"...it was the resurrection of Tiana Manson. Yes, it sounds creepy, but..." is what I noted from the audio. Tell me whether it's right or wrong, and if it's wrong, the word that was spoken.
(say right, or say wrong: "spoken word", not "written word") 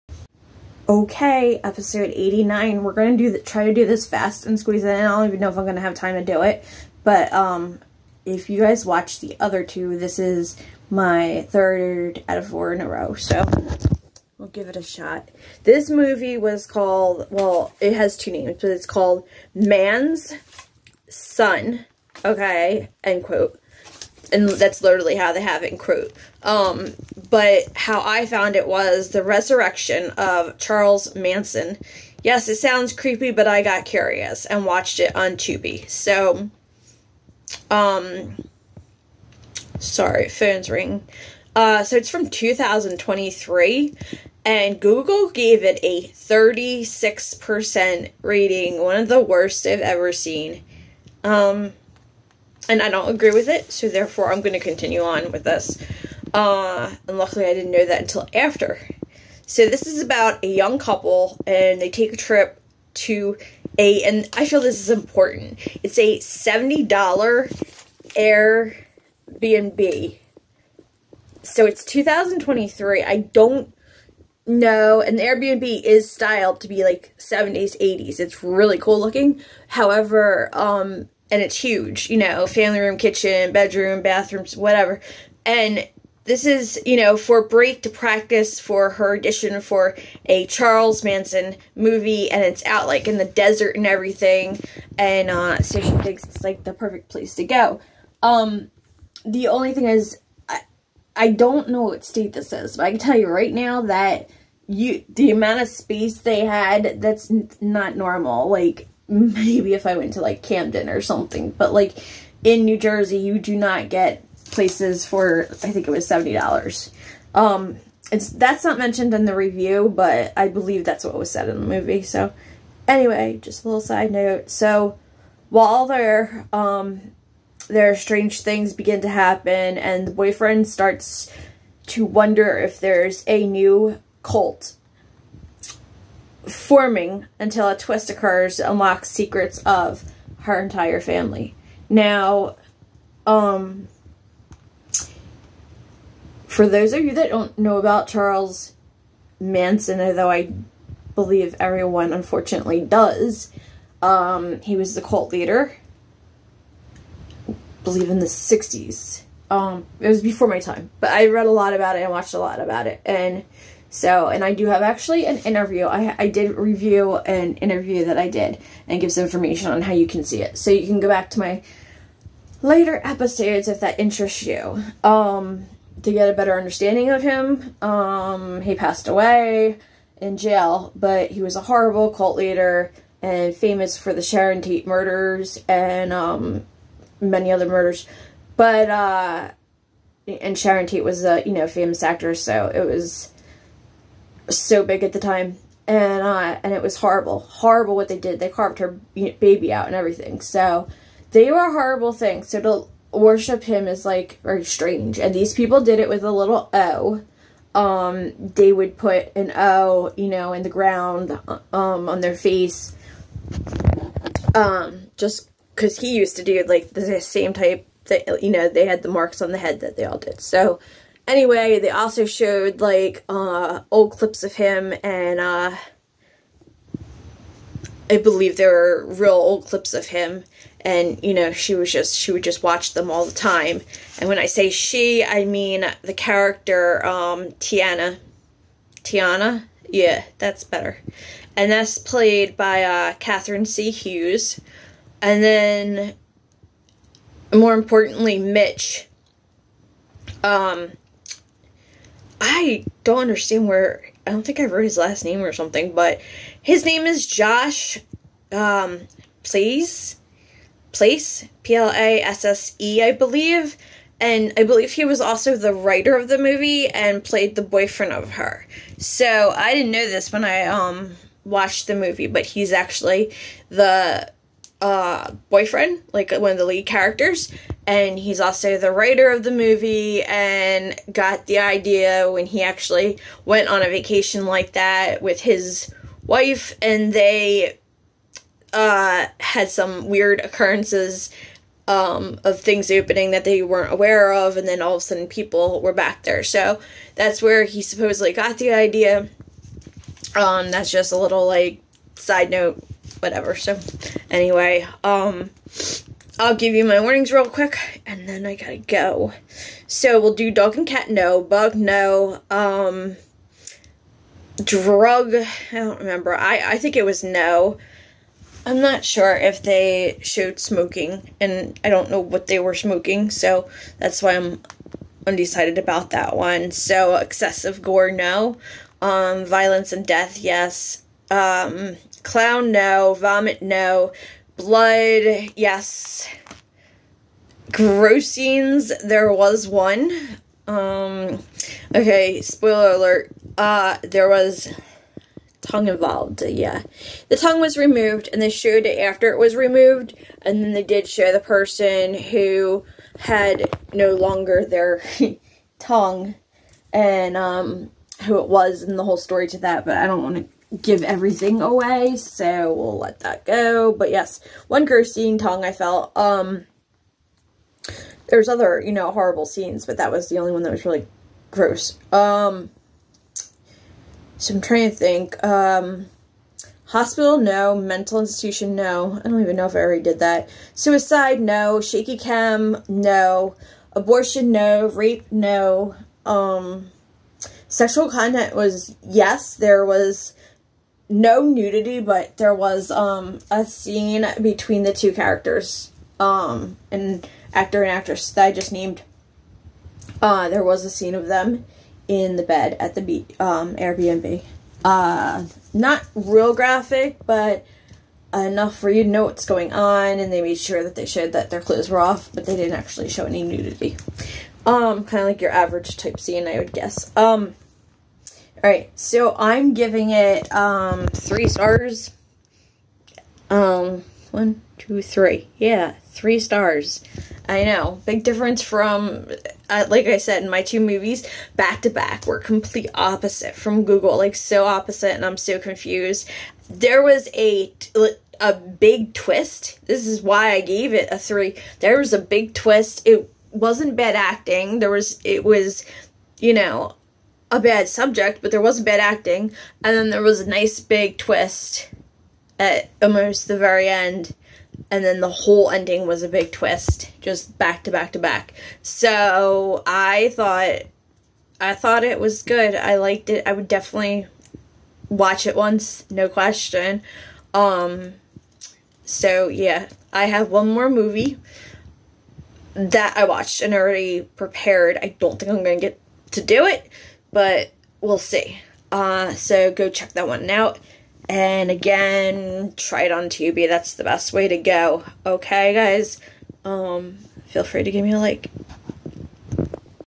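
wrong: "Charles", not "Tiana".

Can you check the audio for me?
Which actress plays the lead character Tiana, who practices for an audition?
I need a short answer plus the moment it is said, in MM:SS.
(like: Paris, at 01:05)
Catherine C Hughes, at 04:03.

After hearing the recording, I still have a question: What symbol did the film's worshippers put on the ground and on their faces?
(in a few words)
An O.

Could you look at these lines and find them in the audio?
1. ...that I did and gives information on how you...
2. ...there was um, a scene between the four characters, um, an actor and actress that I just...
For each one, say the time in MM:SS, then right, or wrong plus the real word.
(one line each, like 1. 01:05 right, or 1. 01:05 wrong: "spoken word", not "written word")
1. 02:48 right
2. 06:32 wrong: "two", not "four".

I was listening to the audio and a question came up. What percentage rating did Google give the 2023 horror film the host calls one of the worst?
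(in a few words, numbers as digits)
36%.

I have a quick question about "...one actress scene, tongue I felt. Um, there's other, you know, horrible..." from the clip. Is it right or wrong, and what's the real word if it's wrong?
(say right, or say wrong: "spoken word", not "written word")
wrong: "gross", not "actress".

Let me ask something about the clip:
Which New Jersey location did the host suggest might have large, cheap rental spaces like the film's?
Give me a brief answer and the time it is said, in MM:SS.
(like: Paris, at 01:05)
Camden, at 01:50.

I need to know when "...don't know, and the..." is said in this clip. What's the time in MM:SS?
01:13.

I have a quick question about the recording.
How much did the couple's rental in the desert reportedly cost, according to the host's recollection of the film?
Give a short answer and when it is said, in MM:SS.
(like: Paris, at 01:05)
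$70, at 01:06.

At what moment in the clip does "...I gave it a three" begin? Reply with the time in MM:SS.
07:20.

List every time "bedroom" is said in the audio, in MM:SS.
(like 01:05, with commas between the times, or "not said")
01:23.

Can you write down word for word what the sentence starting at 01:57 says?
Um, it's, that's not mentioned in the review, but I believe that's what was said in the movie.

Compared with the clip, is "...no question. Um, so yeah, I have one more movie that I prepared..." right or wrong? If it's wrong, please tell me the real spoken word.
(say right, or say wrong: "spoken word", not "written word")
wrong: "watched", not "prepared".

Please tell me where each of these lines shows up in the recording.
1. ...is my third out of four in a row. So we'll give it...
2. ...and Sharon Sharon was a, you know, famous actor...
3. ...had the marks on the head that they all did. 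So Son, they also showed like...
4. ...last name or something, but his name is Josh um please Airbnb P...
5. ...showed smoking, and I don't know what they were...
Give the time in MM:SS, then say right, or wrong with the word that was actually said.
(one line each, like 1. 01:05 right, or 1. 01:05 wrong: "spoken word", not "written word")
1. 00:10 right
2. 03:10 wrong: "Tate", not "Sharon"
3. 03:38 wrong: "Anyway", not "Son"
4. 04:14 wrong: "Plasse", not "Airbnb"
5. 05:20 right.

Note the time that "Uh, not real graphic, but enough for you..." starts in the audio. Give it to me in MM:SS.
06:44.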